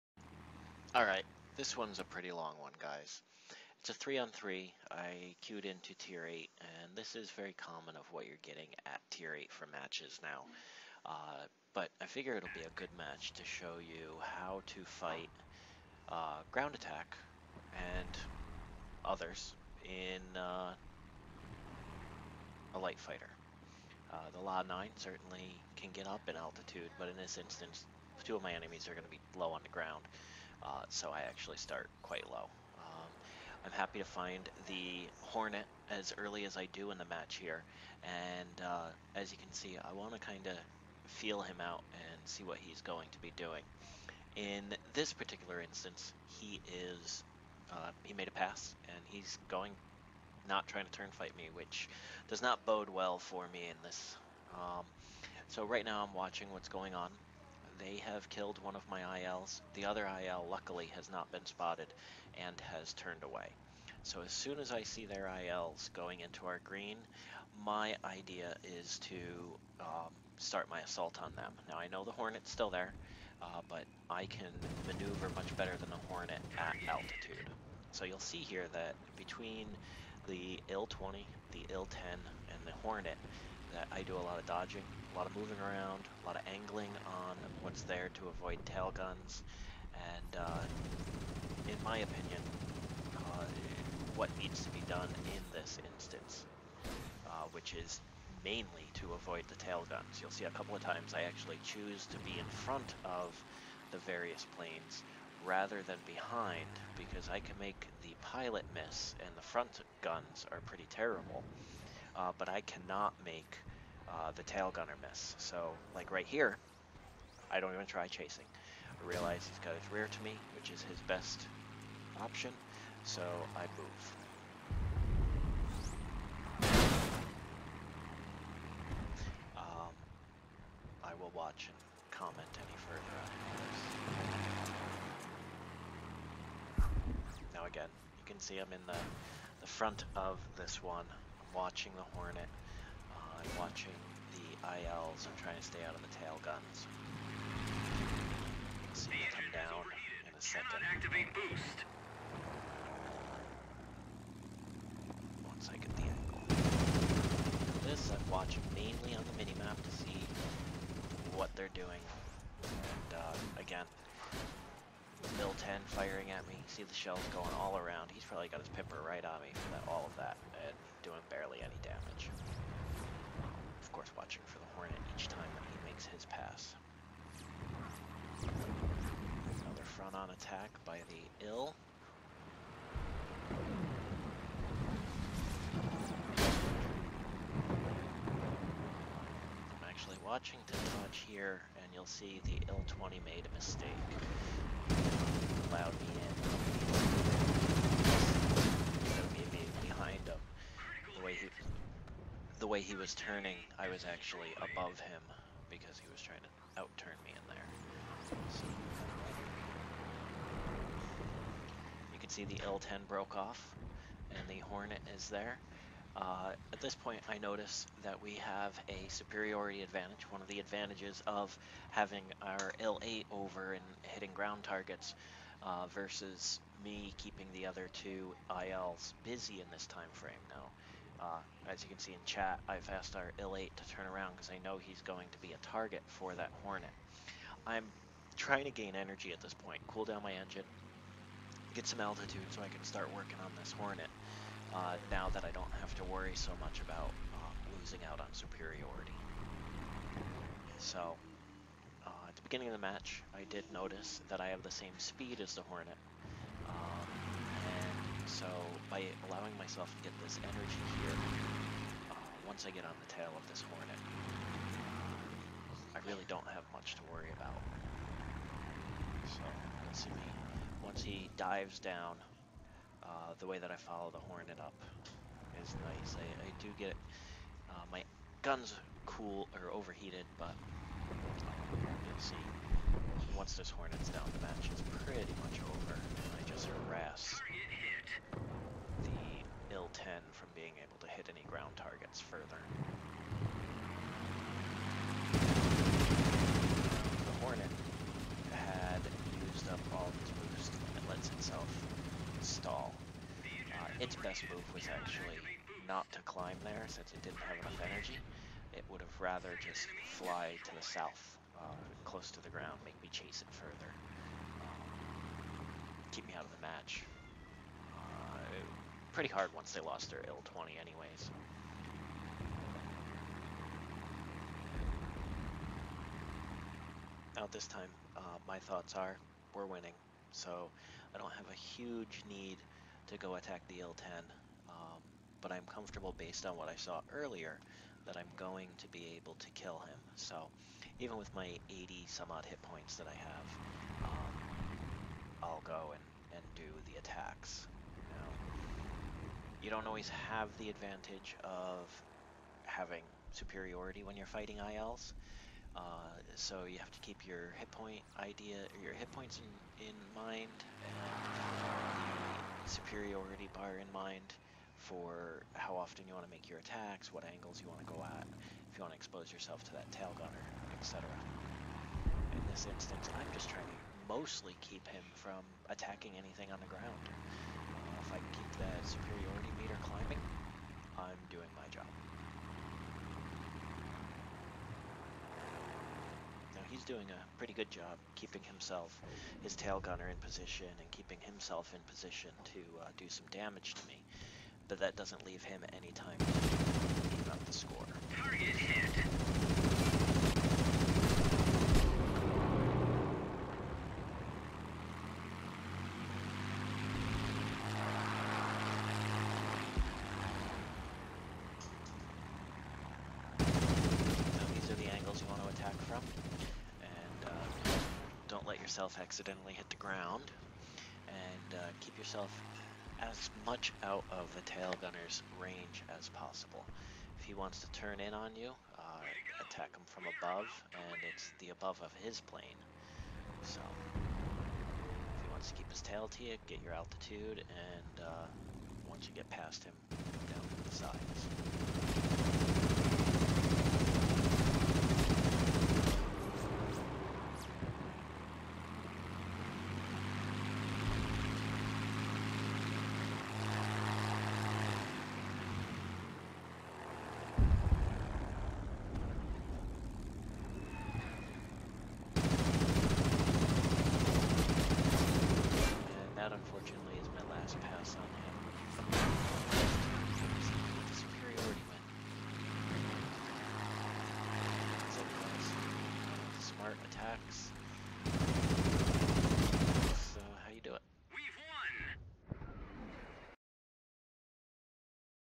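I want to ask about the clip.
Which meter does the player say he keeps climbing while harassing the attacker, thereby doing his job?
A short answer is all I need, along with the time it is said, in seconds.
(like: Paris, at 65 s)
superiority meter, at 378 s.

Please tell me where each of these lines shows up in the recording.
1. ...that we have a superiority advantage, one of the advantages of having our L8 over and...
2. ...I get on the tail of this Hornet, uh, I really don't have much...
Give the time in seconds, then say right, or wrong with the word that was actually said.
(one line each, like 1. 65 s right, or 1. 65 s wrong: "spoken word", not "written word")
1. 218 s right
2. 262 s right.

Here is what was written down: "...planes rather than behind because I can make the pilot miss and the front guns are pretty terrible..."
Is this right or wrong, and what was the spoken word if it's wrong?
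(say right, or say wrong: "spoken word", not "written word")
right.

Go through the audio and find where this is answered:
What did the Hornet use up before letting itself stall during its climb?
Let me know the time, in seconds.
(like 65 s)
299 s.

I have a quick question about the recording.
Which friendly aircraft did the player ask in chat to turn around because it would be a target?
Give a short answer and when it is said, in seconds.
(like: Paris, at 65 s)
IL-8, at 233 s.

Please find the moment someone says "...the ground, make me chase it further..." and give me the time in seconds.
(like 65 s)
312 s.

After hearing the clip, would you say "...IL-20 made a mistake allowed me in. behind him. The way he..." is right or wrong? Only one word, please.
right.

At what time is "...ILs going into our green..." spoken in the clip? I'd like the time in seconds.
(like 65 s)
65 s.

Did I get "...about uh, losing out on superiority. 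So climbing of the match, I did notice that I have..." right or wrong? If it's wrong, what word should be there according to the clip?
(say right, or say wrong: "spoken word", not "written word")
wrong: "beginning", not "climbing".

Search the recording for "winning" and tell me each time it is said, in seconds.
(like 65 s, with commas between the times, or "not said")
329 s.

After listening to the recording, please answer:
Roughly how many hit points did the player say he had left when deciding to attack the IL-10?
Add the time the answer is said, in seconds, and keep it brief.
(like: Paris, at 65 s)
80 some, at 341 s.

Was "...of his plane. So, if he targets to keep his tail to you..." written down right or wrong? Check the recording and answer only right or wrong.
wrong.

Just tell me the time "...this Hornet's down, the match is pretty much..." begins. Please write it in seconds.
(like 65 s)
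283 s.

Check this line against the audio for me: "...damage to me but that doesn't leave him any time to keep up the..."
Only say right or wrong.
right.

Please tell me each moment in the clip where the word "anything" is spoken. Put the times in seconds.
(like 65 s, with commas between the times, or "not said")
376 s.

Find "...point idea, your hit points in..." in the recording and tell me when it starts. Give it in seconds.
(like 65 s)
357 s.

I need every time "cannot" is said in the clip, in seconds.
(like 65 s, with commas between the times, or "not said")
112 s, 150 s.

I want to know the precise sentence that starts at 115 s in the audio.
So, like right here, I don't even try chasing.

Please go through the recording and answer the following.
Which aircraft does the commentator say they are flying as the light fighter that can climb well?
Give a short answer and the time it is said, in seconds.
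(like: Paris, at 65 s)
La 9, at 24 s.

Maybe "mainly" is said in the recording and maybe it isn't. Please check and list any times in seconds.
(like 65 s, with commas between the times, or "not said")
98 s, 158 s.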